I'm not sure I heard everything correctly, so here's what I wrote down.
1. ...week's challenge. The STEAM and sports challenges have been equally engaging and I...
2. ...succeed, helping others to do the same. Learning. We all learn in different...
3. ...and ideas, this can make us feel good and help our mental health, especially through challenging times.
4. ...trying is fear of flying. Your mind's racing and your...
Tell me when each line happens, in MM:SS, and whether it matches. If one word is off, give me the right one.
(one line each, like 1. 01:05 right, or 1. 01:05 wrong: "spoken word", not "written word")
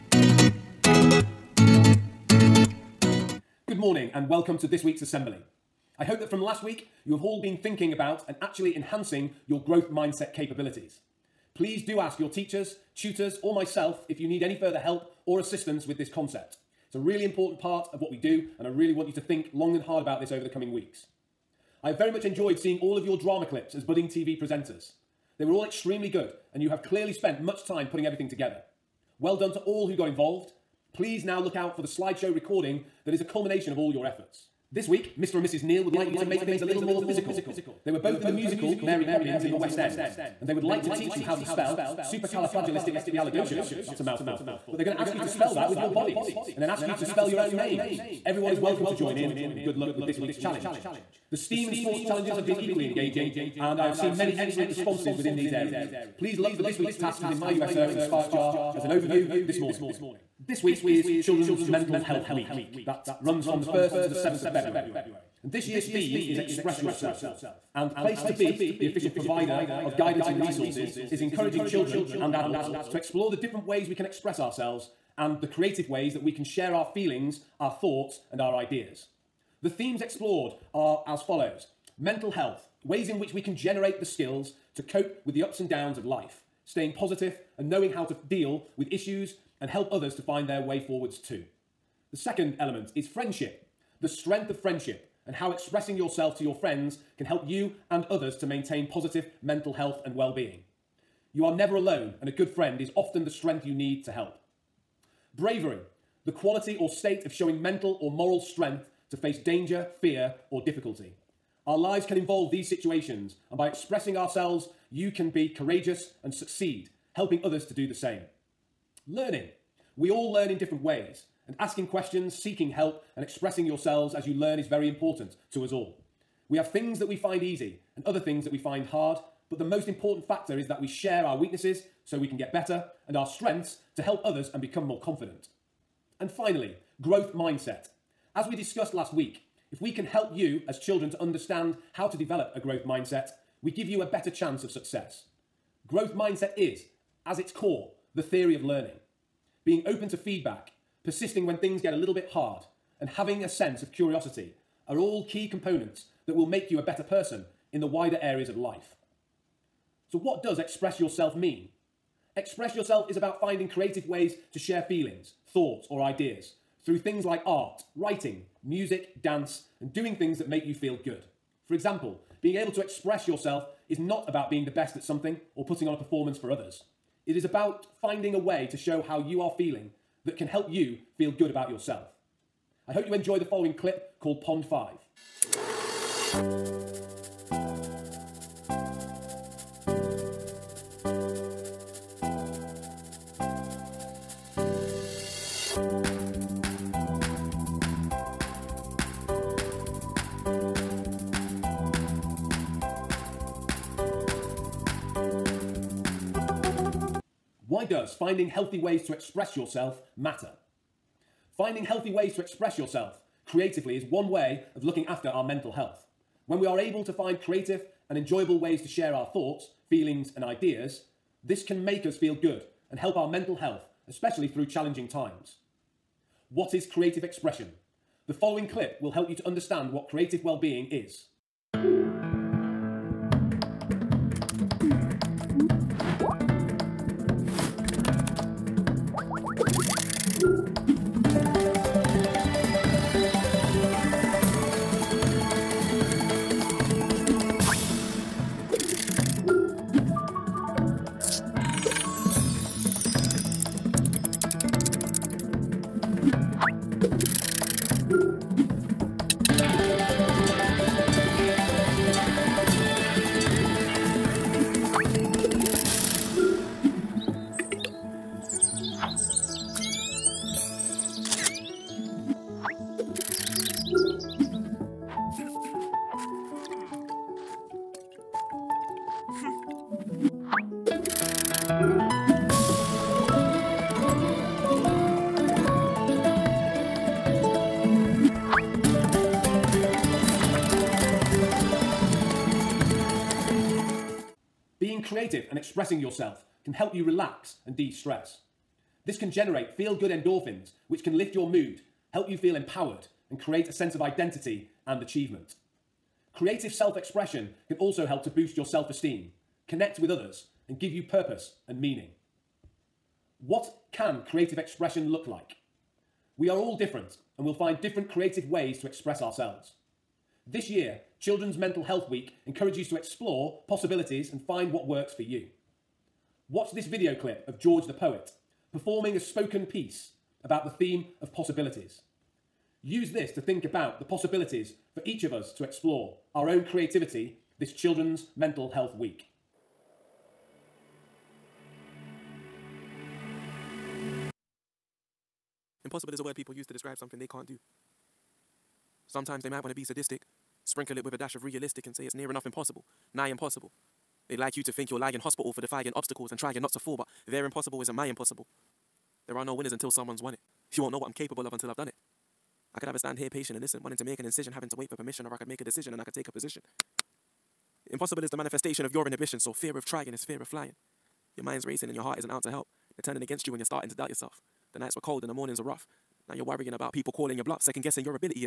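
1. 00:50 right
2. 01:56 right
3. 03:40 right
4. 06:09 right.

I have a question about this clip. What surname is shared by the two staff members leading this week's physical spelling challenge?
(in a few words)
Neal.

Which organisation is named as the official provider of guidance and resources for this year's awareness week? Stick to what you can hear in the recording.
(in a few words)
Place to Be.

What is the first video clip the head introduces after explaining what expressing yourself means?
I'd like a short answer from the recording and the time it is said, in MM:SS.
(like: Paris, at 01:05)
Pond 5, at 03:04.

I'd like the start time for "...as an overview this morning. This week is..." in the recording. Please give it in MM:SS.
00:58.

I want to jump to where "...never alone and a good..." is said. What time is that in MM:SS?
01:41.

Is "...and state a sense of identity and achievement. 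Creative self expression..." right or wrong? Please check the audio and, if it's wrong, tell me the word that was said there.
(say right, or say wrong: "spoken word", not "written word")
wrong: "create", not "state".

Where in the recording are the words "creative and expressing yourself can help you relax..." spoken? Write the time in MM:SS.
04:55.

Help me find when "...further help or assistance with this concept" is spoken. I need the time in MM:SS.
00:14.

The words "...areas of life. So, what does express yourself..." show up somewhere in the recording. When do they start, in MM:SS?
02:38.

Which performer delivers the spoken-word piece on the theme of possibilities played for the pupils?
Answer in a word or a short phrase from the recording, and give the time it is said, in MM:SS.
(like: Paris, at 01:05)
George the Poet, at 05:27.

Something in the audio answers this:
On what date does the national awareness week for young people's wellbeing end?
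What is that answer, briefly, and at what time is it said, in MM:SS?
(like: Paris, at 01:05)
7th of February, at 01:04.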